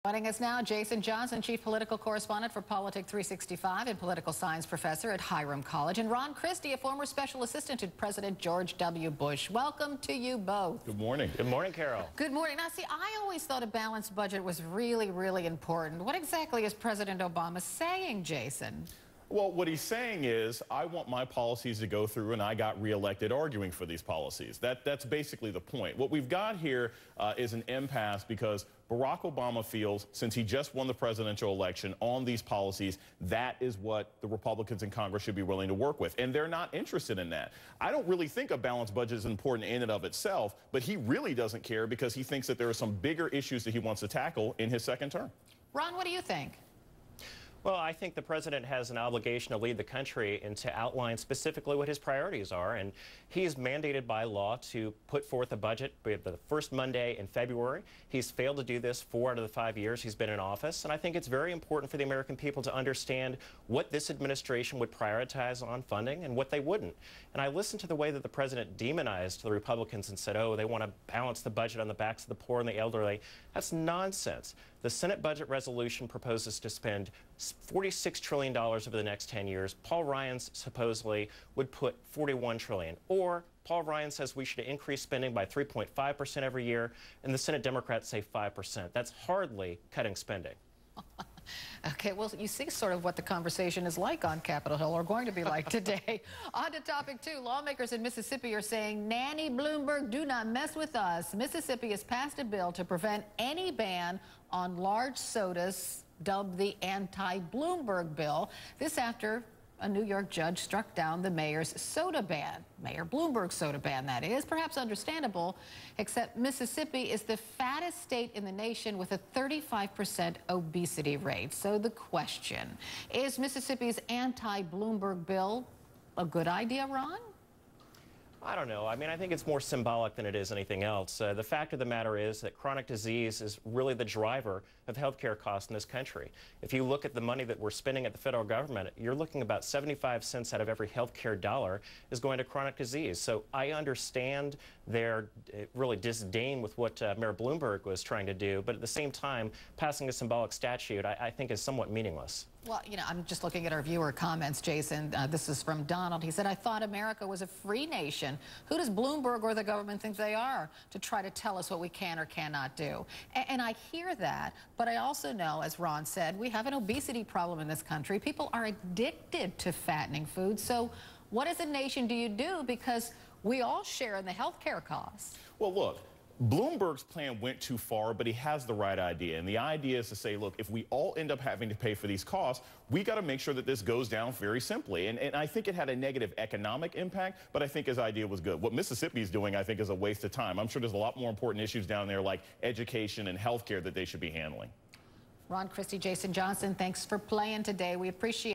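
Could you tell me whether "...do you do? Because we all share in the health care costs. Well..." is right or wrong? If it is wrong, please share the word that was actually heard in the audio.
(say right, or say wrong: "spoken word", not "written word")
right.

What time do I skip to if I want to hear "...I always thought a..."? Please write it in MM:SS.
00:12.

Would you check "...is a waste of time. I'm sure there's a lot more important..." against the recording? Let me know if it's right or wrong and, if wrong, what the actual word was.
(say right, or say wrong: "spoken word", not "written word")
right.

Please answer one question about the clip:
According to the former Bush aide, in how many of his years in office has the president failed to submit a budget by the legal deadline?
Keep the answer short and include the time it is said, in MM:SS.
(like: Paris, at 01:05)
4 out of 5, at 00:59.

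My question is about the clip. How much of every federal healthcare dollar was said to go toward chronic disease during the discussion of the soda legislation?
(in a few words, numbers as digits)
75 cents.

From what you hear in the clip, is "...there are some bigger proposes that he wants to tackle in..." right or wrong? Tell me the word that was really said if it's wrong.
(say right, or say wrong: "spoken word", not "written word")
wrong: "issues", not "proposes".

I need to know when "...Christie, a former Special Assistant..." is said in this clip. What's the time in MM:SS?
00:06.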